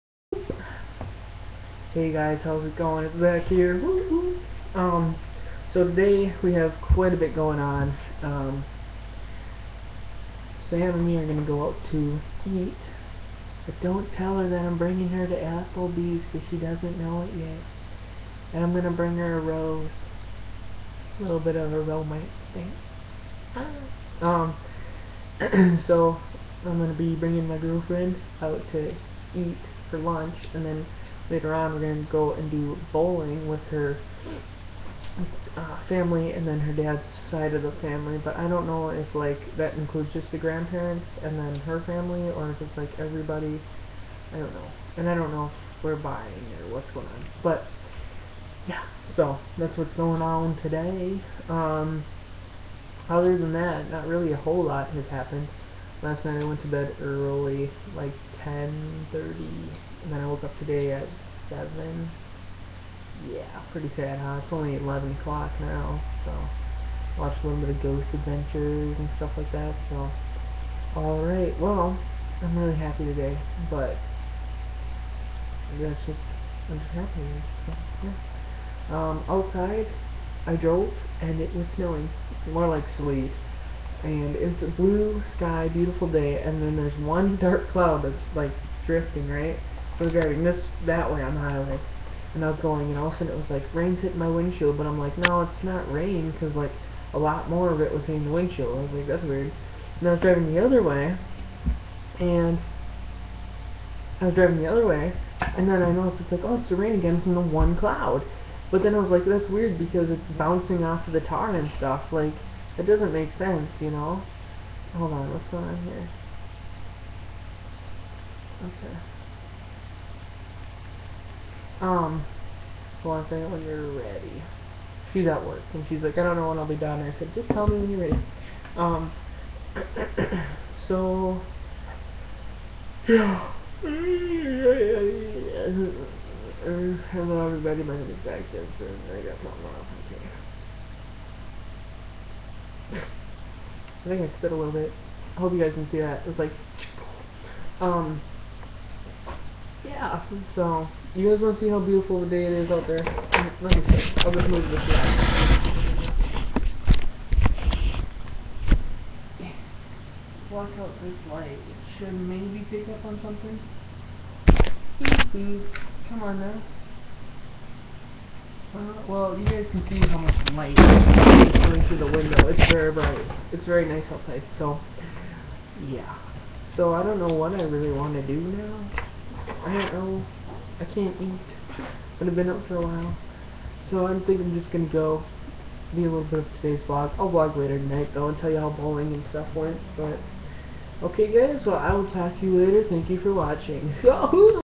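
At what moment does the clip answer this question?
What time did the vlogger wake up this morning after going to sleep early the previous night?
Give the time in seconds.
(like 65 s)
61 s.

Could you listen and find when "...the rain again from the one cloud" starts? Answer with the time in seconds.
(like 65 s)
106 s.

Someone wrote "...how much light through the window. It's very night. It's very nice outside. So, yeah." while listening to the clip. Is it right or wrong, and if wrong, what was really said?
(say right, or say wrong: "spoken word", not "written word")
wrong: "bright", not "night".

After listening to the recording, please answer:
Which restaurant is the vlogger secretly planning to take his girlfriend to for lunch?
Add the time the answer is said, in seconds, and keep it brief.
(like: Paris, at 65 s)
Applebee's, at 15 s.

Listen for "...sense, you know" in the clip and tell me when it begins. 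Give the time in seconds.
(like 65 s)
113 s.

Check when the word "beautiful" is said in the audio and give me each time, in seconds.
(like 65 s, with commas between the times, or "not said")
85 s, 151 s.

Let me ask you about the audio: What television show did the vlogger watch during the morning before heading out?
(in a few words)
Ghost Adventures.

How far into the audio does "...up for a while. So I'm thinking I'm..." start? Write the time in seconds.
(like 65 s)
182 s.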